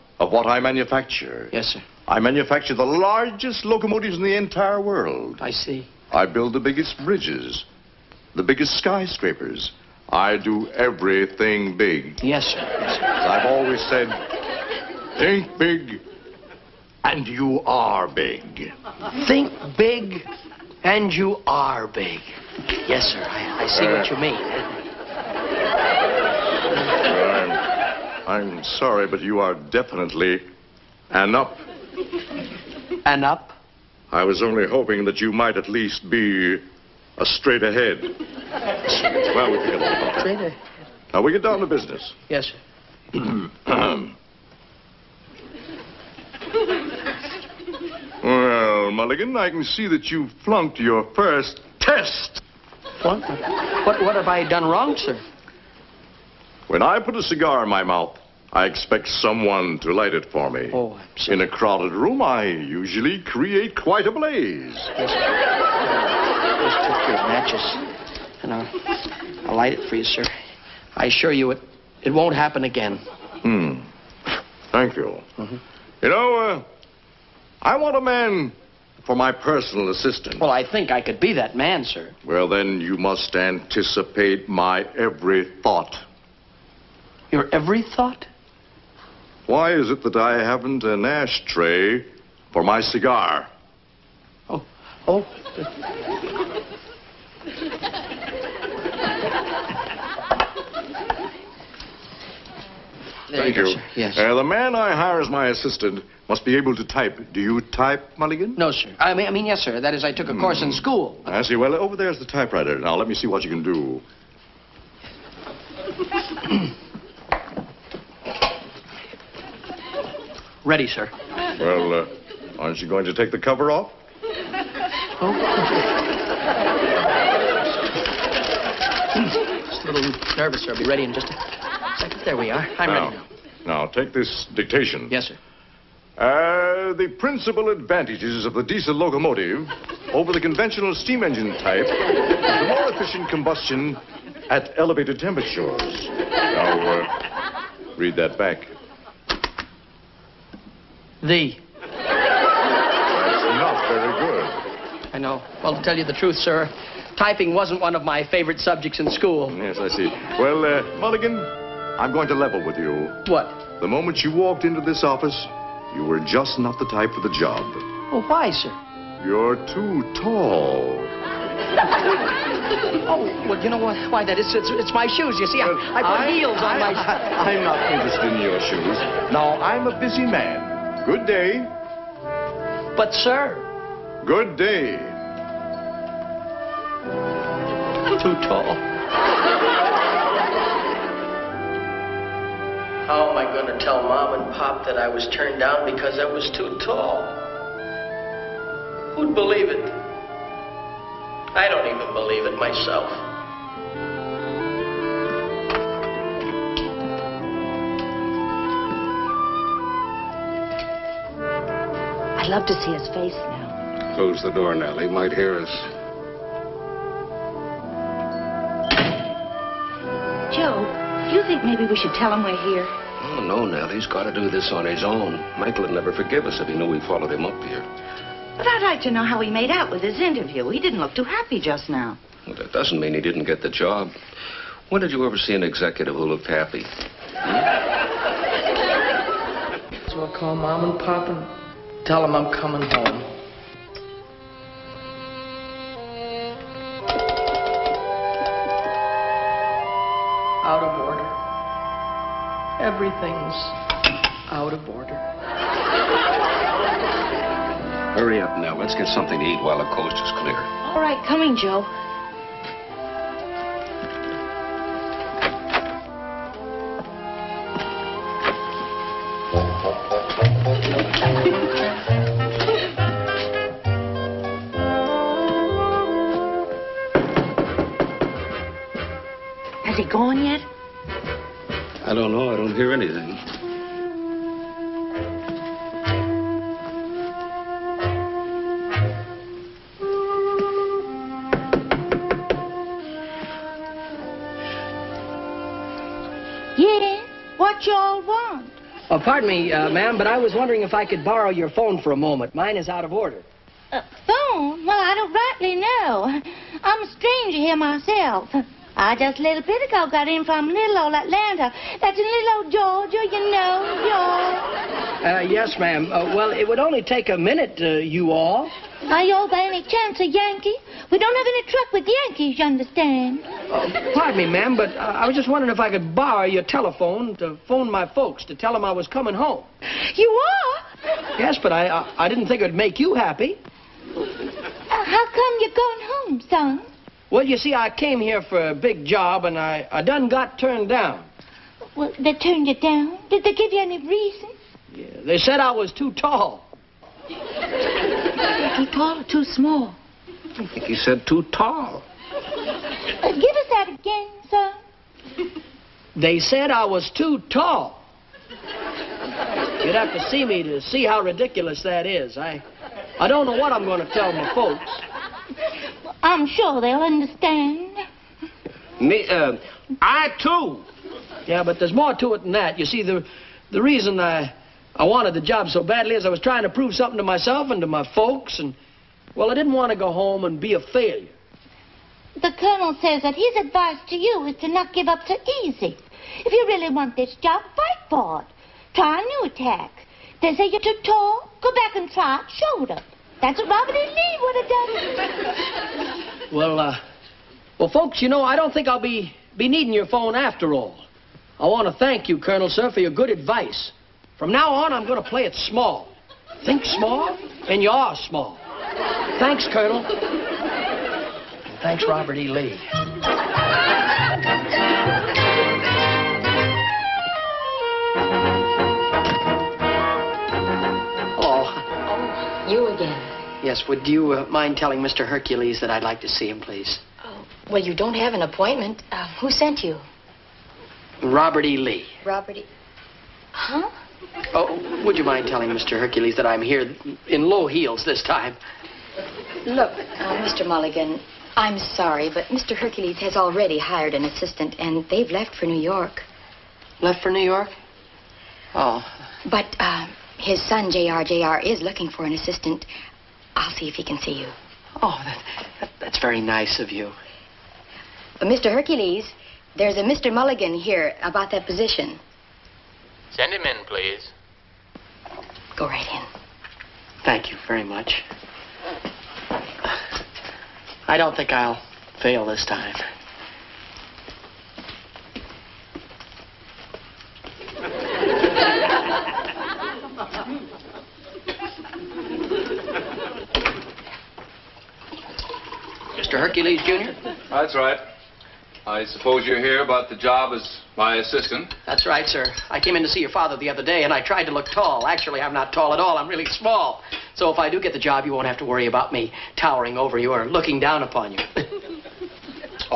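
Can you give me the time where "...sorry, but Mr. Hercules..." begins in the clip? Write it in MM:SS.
07:21.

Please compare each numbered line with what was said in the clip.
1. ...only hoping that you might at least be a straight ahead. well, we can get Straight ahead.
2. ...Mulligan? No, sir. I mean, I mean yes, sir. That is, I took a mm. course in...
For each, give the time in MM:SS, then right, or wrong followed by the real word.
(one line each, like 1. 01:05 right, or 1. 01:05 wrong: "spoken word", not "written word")
1. 00:34 right
2. 01:48 right.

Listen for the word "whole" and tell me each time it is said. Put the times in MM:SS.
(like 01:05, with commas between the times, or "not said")
not said.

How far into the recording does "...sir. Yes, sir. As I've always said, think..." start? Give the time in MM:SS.
00:12.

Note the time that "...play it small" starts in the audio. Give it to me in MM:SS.
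06:45.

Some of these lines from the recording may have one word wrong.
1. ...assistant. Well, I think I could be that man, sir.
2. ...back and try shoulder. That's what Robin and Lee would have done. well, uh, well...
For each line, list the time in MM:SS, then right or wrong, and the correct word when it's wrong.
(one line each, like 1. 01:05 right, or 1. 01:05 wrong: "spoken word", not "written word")
1. 01:19 right
2. 06:31 right.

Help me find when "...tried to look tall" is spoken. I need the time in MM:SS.
08:14.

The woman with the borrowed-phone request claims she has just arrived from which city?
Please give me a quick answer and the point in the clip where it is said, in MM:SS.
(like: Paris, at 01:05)
Atlanta, at 05:11.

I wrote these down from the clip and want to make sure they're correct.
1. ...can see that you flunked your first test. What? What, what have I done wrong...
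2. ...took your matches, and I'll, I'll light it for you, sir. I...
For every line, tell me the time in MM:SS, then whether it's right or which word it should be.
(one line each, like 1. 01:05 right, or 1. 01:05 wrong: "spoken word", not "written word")
1. 00:49 right
2. 01:06 right.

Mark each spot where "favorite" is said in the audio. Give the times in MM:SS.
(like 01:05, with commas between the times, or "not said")
02:38.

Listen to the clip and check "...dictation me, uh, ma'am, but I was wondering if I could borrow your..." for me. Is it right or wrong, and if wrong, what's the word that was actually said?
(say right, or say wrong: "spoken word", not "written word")
wrong: "pardon", not "dictation".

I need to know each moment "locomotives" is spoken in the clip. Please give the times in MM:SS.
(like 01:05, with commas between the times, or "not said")
00:03, 02:18.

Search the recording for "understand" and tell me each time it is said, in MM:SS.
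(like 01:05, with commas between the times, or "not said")
05:22, 06:07.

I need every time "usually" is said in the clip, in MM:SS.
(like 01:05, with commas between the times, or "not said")
01:02.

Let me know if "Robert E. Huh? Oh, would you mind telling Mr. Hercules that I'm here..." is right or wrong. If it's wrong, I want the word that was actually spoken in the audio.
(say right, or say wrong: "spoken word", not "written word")
right.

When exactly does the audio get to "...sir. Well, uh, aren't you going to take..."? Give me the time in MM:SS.
02:00.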